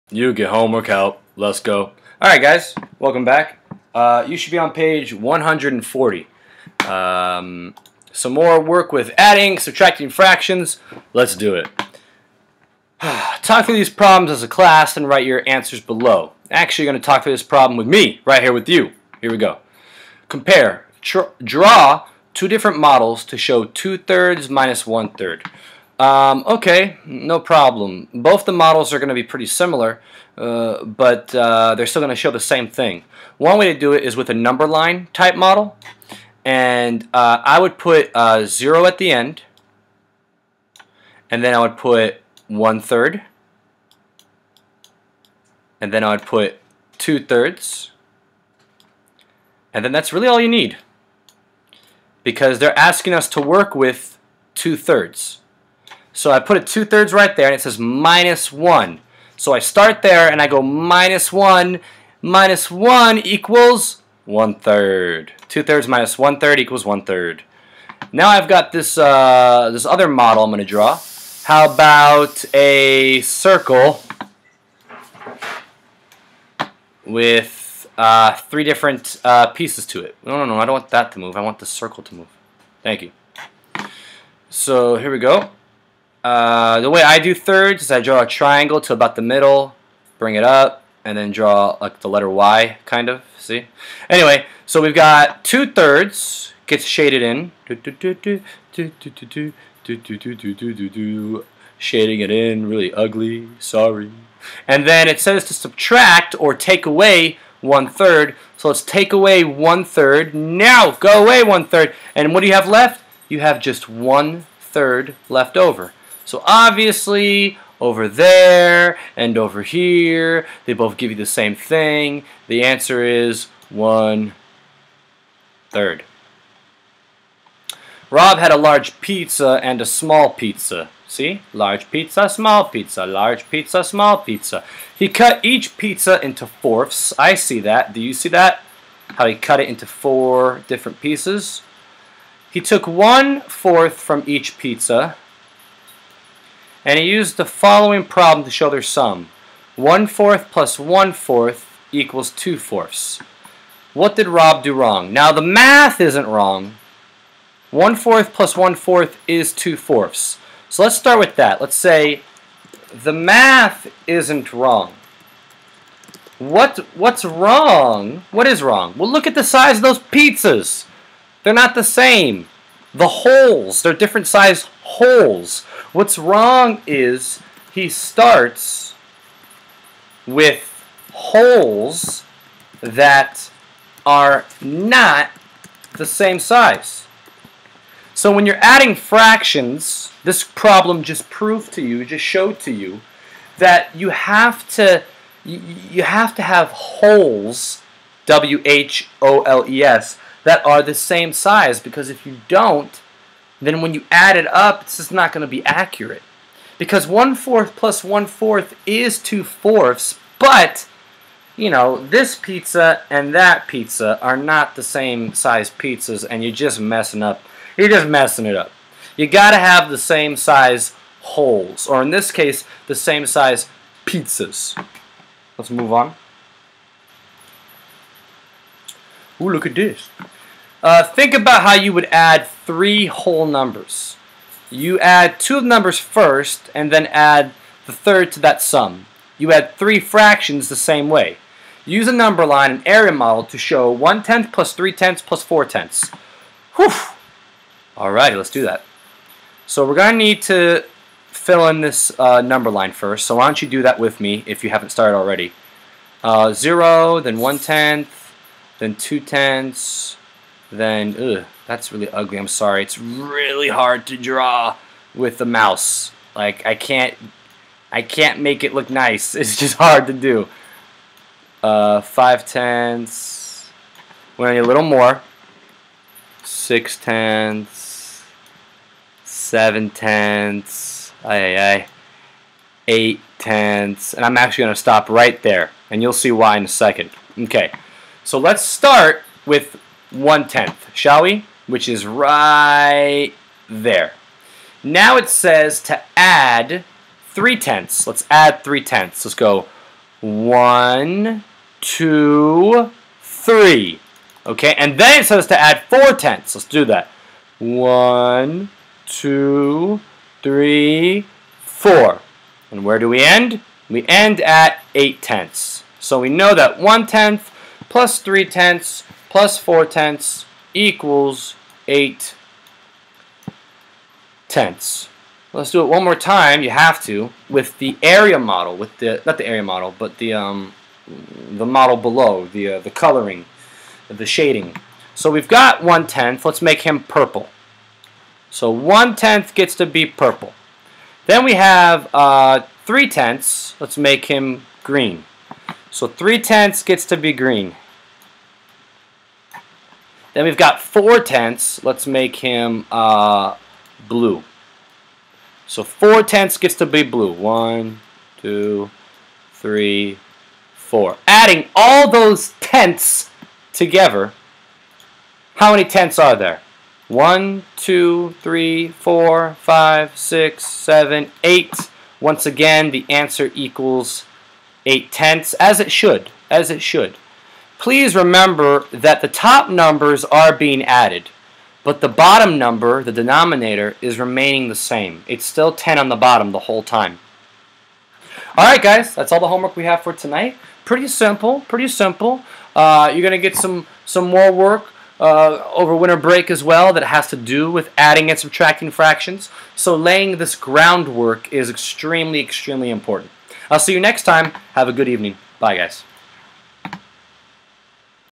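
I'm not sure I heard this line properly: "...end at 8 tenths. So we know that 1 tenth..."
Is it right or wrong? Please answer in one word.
right.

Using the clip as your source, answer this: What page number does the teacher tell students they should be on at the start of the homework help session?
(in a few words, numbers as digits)
140.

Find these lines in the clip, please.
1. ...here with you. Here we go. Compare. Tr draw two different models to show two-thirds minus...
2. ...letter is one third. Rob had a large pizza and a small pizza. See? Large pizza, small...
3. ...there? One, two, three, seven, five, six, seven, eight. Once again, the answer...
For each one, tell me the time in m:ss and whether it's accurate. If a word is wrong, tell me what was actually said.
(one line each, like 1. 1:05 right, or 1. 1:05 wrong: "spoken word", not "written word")
1. 0:18 right
2. 2:02 wrong: "answer", not "letter"
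3. 6:06 wrong: "four", not "seven".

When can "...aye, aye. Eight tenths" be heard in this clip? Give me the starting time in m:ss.
4:41.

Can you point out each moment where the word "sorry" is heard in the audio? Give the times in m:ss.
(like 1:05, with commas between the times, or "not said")
1:43, 4:22.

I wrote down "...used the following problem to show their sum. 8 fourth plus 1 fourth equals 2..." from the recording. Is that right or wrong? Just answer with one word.
wrong.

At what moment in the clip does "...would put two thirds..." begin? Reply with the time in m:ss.
0:46.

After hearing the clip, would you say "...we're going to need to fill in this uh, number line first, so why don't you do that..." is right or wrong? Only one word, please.
right.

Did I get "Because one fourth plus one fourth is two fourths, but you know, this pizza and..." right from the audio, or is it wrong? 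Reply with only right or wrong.
right.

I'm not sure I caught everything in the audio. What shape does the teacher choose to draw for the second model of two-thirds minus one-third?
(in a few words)
A circle.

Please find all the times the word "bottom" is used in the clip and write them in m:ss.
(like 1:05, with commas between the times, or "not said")
6:22, 6:26.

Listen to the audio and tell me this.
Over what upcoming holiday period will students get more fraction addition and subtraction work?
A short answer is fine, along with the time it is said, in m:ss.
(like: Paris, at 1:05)
Winter break, at 6:35.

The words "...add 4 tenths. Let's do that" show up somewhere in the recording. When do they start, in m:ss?
5:05.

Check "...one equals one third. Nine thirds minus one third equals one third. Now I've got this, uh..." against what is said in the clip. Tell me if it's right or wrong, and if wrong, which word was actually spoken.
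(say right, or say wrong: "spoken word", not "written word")
wrong: "Two", not "Nine".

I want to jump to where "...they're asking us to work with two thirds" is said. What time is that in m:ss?
0:52.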